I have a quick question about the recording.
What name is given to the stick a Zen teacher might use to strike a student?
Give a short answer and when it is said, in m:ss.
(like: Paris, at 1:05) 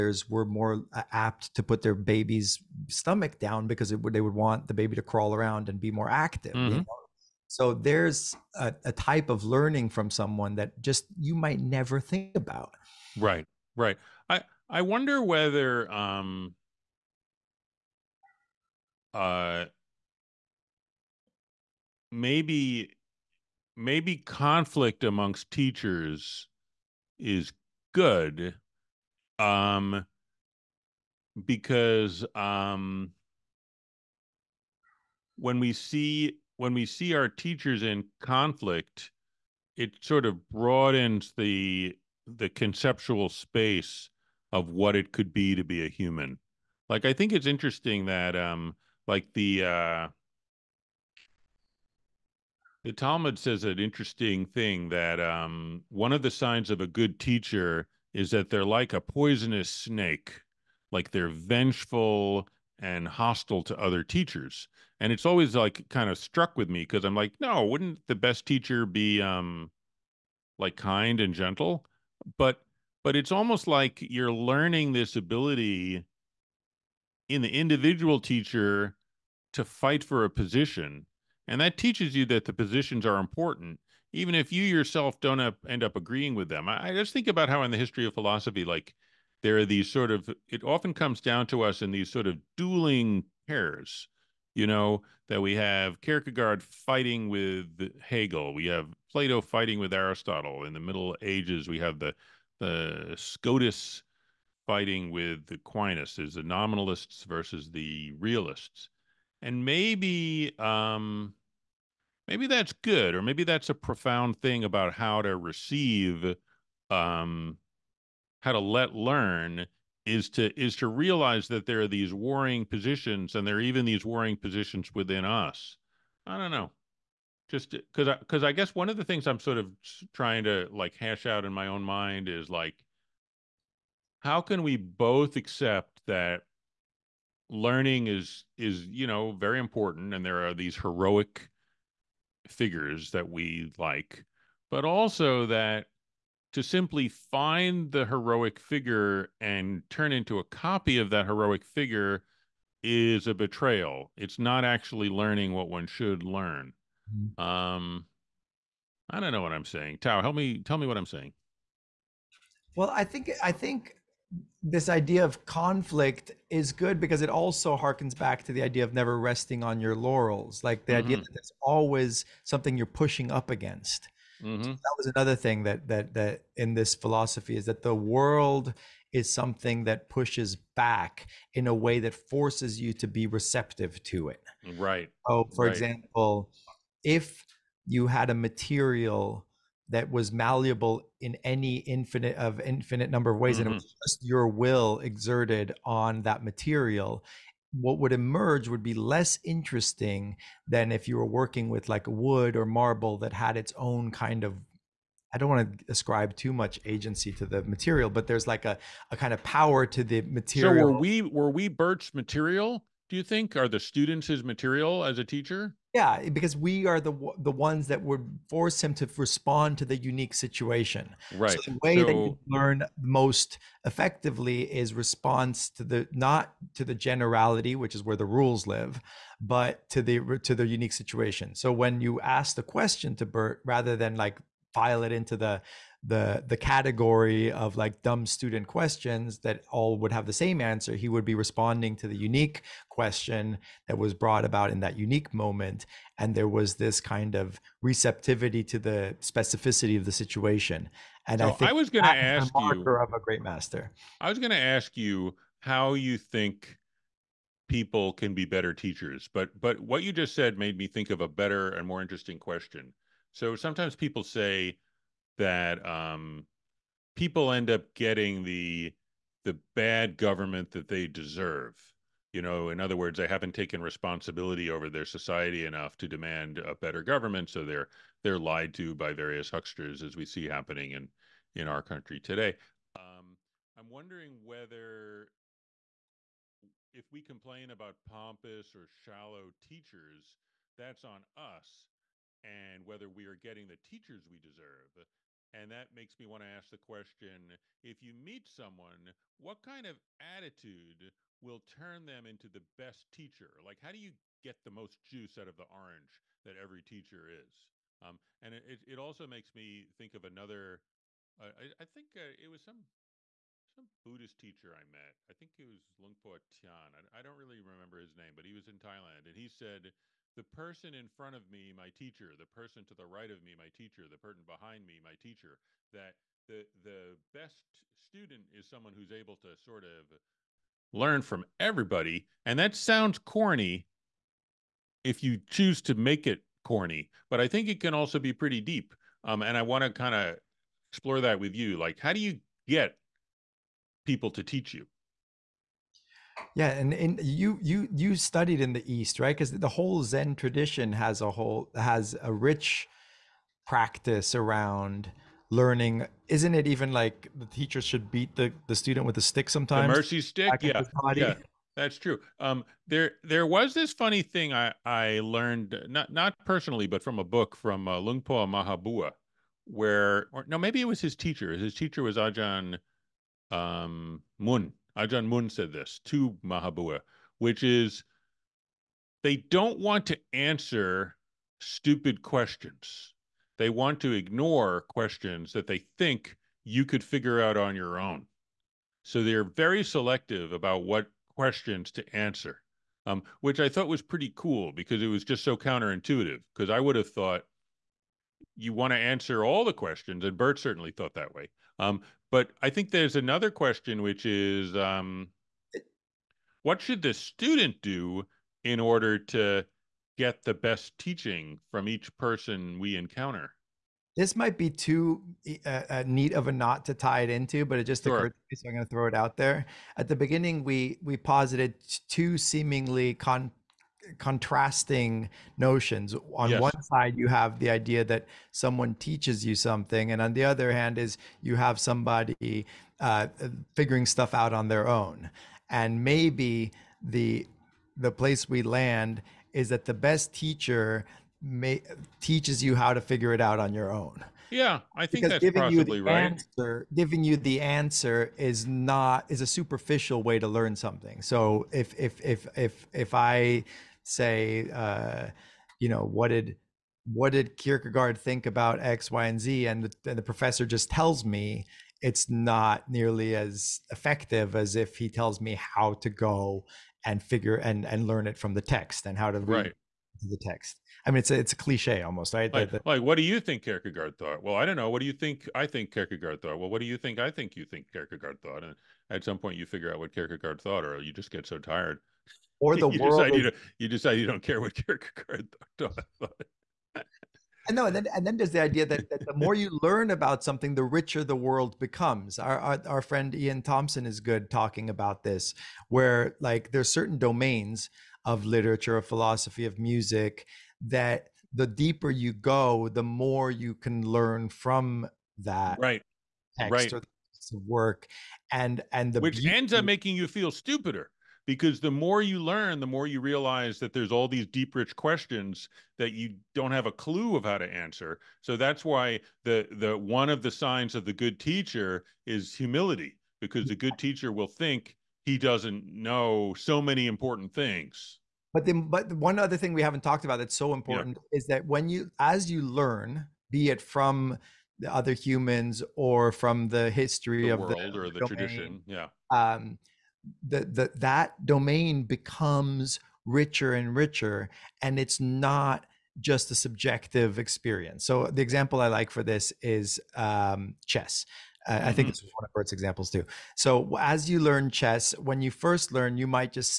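The mercy stick, at 5:59.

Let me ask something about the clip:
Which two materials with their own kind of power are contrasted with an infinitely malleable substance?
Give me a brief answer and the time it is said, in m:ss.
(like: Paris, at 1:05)
wood or marble, at 3:22.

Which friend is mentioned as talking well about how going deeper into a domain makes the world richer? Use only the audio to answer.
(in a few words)
Iain Thomson.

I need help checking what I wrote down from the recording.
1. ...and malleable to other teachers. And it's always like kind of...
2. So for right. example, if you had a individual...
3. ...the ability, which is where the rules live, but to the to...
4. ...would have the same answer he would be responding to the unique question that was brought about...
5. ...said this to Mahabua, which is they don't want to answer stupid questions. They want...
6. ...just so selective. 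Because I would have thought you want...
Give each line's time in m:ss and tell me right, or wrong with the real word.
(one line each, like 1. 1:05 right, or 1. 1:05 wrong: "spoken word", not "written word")
1. 1:02 wrong: "hostile", not "malleable"
2. 3:05 wrong: "material", not "individual"
3. 3:46 wrong: "generality", not "ability"
4. 3:59 right
5. 6:15 right
6. 6:35 wrong: "counterintuitive", not "selective".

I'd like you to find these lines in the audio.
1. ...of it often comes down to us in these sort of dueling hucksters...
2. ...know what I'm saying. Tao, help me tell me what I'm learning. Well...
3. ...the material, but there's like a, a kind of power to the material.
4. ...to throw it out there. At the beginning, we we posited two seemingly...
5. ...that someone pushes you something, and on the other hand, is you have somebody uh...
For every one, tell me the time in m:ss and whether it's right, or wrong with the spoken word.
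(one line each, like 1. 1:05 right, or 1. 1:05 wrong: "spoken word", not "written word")
1. 1:30 wrong: "pairs", not "hucksters"
2. 2:39 wrong: "saying", not "learning"
3. 3:27 right
4. 6:58 right
5. 7:08 wrong: "teaches", not "pushes".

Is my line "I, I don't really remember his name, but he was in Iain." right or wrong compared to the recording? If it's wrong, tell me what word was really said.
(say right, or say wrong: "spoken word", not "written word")
wrong: "Thailand", not "Iain".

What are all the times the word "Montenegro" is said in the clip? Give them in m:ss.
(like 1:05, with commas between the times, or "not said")
not said.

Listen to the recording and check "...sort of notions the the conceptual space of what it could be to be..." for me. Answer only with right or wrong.
wrong.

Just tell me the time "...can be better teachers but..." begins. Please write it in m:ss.
4:18.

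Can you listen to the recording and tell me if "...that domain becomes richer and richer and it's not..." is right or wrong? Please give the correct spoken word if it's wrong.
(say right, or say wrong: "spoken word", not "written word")
right.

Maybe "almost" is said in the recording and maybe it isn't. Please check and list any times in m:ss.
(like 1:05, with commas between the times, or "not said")
1:13, 7:52.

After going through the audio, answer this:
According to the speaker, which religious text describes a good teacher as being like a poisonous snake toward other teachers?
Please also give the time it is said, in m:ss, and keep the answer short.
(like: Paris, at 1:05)
The Talmud, at 0:52.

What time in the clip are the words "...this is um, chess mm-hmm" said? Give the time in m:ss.
9:09.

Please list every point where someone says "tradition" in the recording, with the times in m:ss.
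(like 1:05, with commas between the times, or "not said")
5:50, 8:58.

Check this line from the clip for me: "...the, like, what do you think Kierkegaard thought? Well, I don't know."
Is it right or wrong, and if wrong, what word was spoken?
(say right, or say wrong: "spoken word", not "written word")
right.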